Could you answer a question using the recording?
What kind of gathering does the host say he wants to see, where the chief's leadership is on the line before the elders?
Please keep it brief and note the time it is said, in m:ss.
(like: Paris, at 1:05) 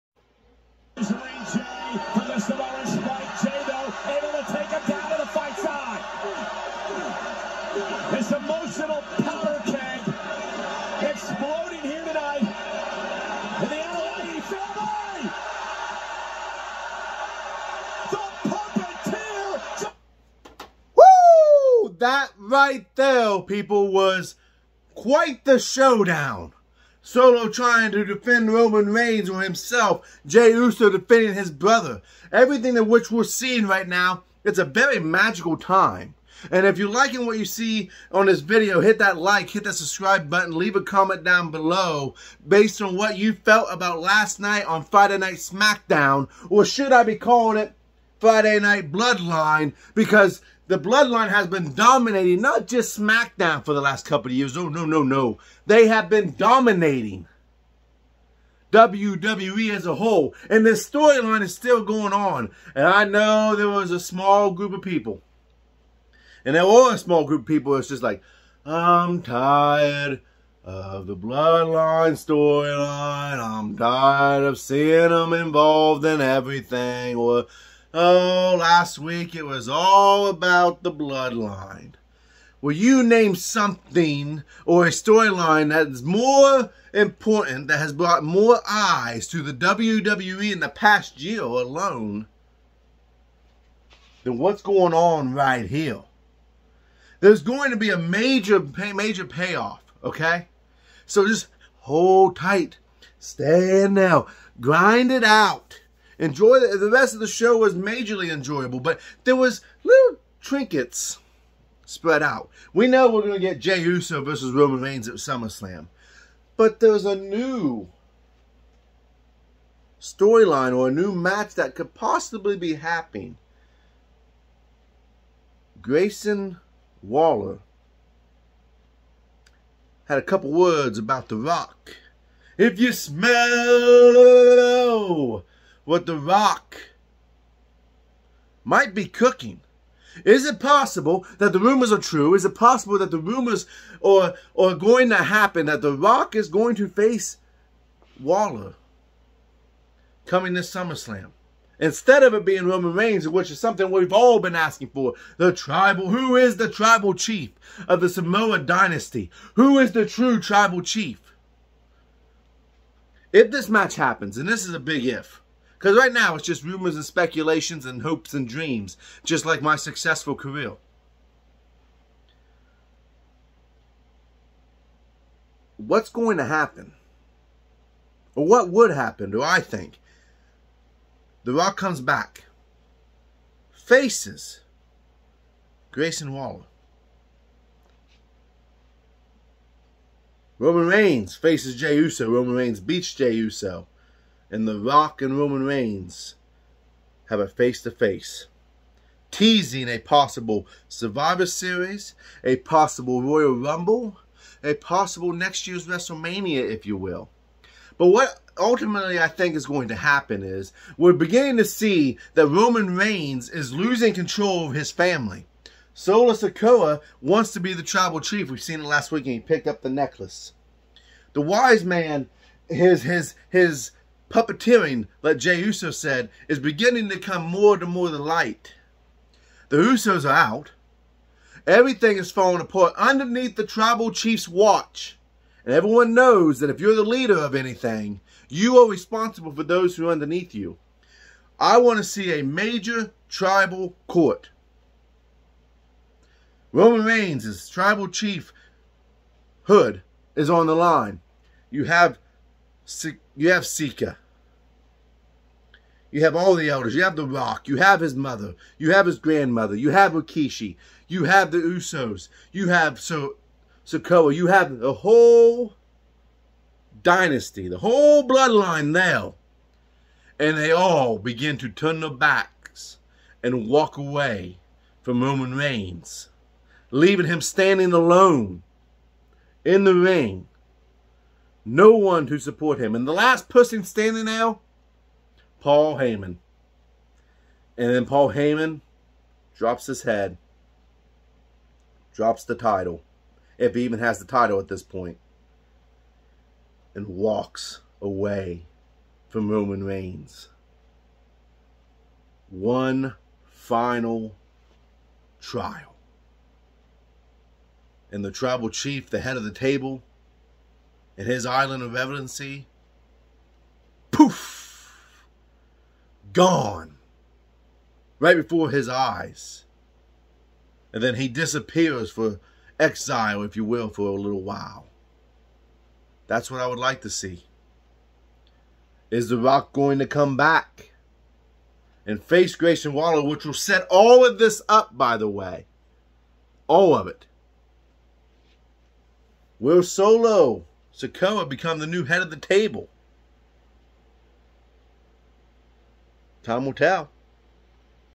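tribal court, at 4:03.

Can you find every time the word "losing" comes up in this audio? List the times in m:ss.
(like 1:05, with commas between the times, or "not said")
3:33.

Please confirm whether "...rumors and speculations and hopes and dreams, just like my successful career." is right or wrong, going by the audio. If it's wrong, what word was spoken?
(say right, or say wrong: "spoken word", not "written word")
right.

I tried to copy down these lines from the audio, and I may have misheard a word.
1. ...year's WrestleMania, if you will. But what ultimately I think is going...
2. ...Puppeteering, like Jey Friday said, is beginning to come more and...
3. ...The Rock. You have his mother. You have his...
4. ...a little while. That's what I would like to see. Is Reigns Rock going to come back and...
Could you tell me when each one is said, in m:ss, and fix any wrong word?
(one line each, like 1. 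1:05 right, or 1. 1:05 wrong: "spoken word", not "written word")
1. 3:25 right
2. 3:44 wrong: "Uso", not "Friday"
3. 4:17 right
4. 5:24 wrong: "The", not "Reigns".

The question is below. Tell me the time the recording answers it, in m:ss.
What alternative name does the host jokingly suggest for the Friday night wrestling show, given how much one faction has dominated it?
0:48.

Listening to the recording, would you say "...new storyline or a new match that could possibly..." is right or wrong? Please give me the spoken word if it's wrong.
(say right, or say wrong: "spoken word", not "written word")
right.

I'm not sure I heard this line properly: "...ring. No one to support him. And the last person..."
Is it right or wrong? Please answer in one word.
right.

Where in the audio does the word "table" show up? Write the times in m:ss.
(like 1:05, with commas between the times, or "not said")
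5:09, 5:42.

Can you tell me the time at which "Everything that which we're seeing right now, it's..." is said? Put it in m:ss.
0:32.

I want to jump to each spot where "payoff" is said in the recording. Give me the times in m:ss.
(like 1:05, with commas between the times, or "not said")
1:39.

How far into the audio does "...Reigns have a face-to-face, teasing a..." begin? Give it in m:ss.
3:15.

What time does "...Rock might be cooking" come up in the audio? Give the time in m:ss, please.
2:16.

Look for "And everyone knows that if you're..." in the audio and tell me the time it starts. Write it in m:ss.
3:55.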